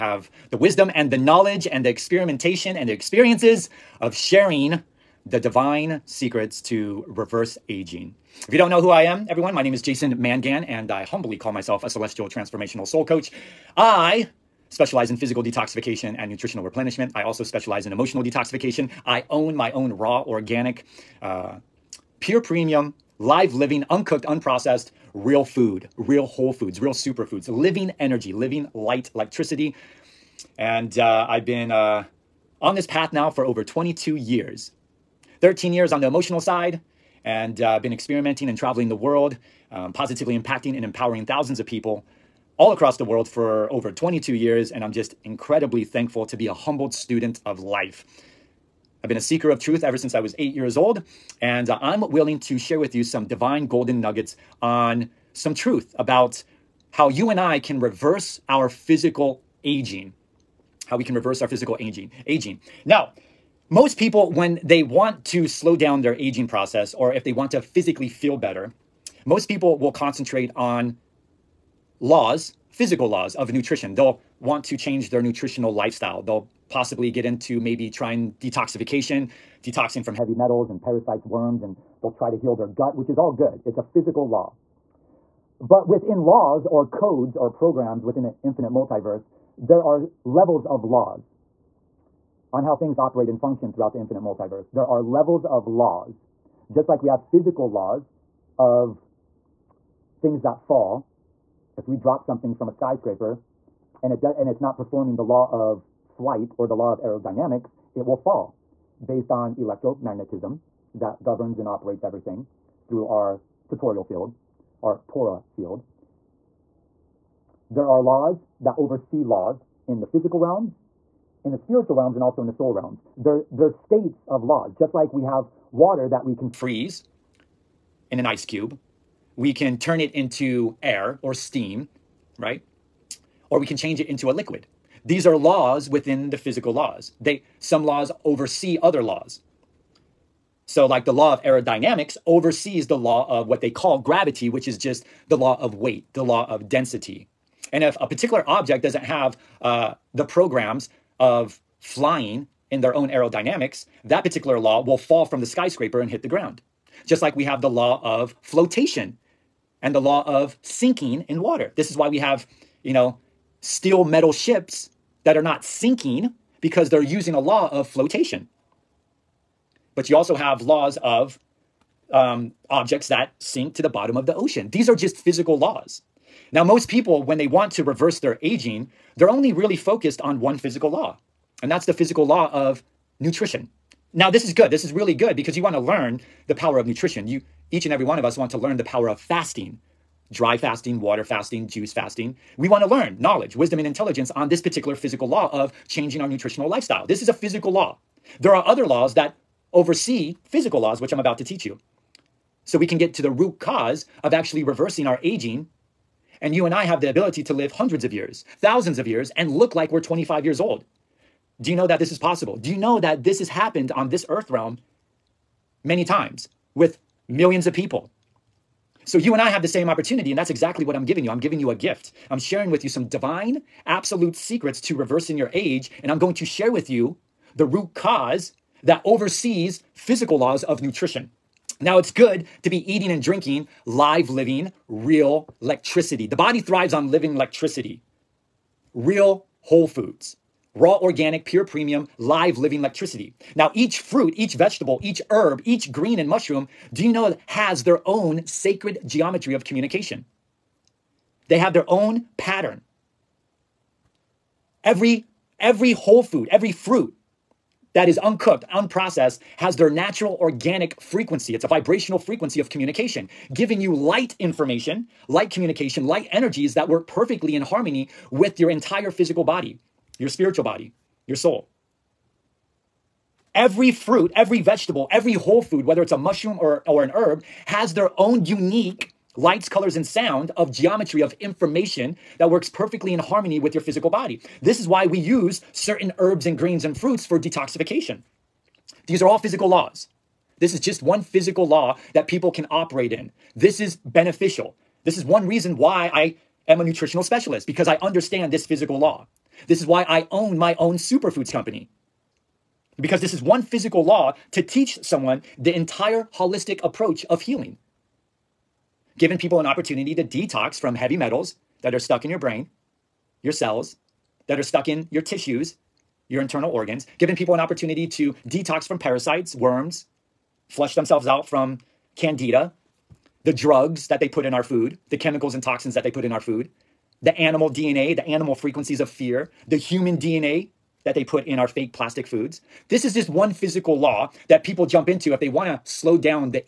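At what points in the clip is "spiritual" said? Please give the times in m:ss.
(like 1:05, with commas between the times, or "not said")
2:01, 4:30.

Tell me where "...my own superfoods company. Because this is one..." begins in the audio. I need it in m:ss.
5:00.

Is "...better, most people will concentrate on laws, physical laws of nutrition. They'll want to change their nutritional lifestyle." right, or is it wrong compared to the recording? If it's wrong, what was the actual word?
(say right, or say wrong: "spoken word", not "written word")
right.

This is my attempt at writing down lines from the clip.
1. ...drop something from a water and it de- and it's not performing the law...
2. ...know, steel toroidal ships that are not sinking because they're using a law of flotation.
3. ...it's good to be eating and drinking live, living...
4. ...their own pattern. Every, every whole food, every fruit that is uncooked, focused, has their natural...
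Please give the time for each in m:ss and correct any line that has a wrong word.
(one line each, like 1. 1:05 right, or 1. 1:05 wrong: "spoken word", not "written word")
1. 1:41 wrong: "skyscraper", not "water"
2. 2:42 wrong: "metal", not "toroidal"
3. 3:51 right
4. 4:11 wrong: "unprocessed", not "focused".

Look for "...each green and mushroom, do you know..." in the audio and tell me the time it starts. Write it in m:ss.
4:05.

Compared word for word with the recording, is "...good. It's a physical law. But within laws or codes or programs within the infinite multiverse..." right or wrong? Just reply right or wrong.
right.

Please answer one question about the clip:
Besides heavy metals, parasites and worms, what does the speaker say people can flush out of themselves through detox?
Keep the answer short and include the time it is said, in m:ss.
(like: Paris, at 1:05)
candida, at 5:22.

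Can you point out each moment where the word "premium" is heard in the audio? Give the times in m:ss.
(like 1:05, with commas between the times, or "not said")
0:22, 4:01.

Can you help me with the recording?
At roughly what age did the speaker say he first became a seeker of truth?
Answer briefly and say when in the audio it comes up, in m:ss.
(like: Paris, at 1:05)
8, at 0:50.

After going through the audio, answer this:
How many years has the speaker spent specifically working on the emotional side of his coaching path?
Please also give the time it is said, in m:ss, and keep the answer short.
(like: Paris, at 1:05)
13, at 0:35.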